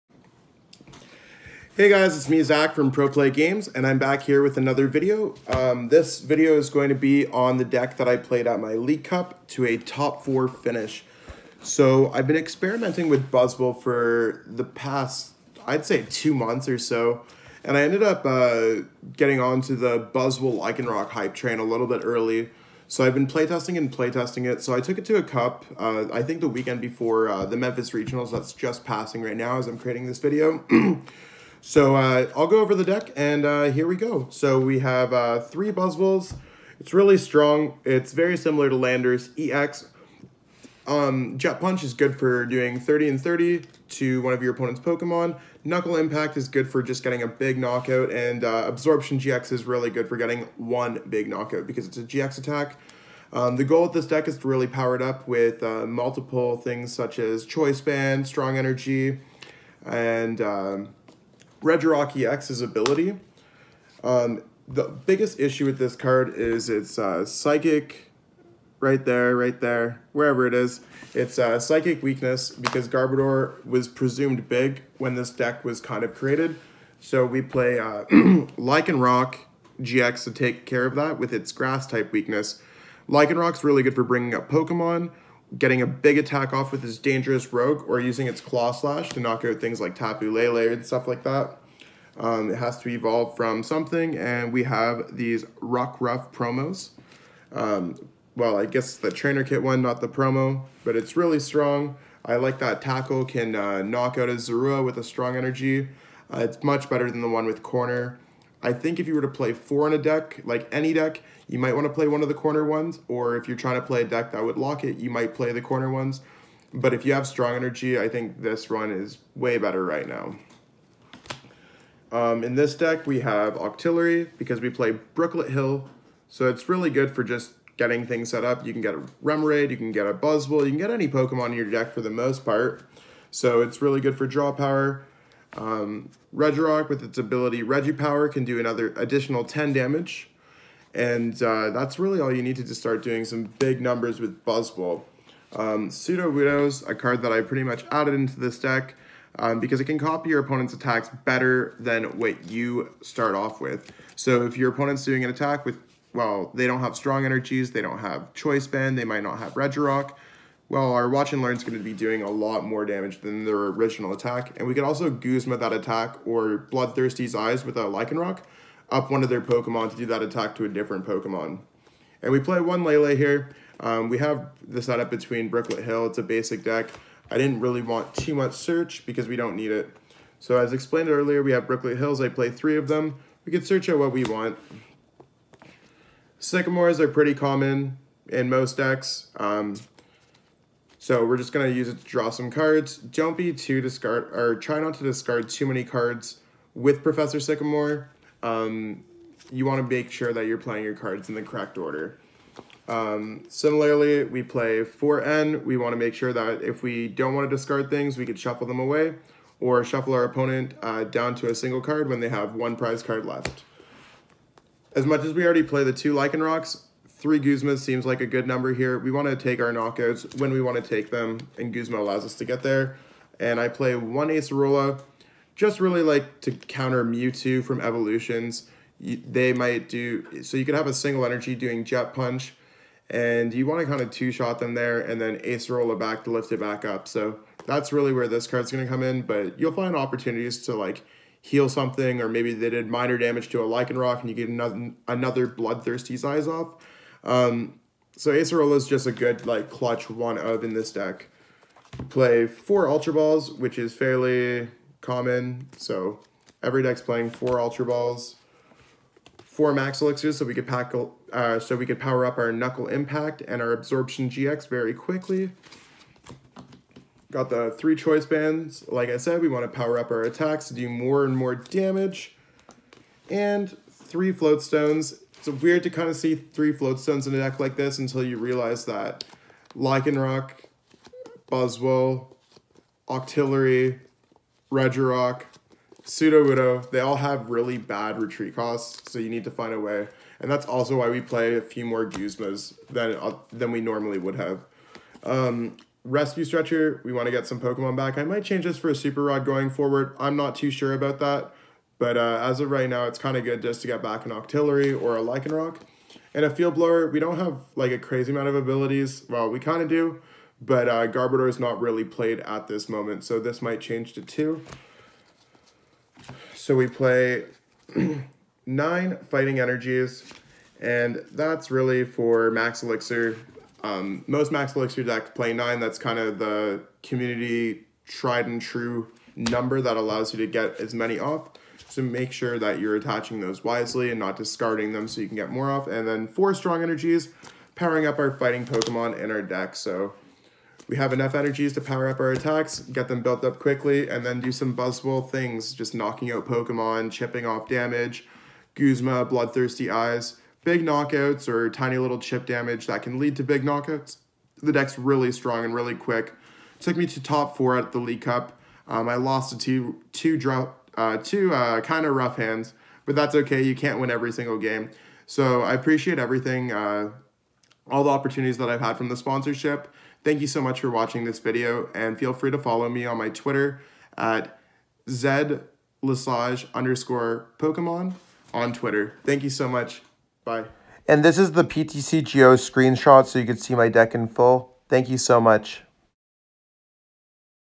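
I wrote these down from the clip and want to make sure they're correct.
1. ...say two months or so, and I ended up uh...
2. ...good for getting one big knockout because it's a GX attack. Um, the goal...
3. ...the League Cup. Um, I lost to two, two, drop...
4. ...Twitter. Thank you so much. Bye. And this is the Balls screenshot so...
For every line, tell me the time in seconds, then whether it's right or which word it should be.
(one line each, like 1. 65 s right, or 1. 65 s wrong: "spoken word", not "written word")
1. 15 s right
2. 49 s right
3. 357 s right
4. 378 s wrong: "PTCGO", not "Balls".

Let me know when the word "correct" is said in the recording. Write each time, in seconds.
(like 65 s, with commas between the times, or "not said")
201 s.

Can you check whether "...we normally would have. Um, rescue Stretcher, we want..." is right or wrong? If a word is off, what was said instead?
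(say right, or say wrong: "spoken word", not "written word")
right.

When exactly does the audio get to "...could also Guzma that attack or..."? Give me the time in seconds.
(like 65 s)
164 s.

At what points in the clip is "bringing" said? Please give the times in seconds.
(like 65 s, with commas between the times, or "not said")
84 s.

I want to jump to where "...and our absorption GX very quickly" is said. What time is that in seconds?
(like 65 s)
263 s.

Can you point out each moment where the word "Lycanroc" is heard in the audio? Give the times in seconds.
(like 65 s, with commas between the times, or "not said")
78 s, 83 s, 167 s, 216 s, 243 s, 279 s, 305 s.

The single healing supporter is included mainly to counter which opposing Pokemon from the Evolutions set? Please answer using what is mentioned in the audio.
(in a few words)
Mewtwo.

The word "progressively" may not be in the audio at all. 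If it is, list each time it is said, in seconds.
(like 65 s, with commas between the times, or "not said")
not said.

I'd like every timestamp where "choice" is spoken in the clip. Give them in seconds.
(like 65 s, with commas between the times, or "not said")
57 s, 158 s, 267 s.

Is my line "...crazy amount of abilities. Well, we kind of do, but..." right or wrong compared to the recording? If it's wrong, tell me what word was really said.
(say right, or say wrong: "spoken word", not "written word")
right.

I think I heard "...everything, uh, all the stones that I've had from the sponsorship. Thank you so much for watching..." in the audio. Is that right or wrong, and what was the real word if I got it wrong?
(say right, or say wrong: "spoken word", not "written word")
wrong: "opportunities", not "stones".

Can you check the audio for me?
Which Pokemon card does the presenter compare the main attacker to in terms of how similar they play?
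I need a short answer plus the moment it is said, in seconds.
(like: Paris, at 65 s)
Landorus EX, at 38 s.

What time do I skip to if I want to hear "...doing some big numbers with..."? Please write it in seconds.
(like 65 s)
143 s.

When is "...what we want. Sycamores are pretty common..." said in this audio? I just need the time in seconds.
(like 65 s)
183 s.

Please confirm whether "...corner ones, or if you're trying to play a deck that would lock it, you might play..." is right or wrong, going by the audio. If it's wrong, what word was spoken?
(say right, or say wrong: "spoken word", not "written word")
right.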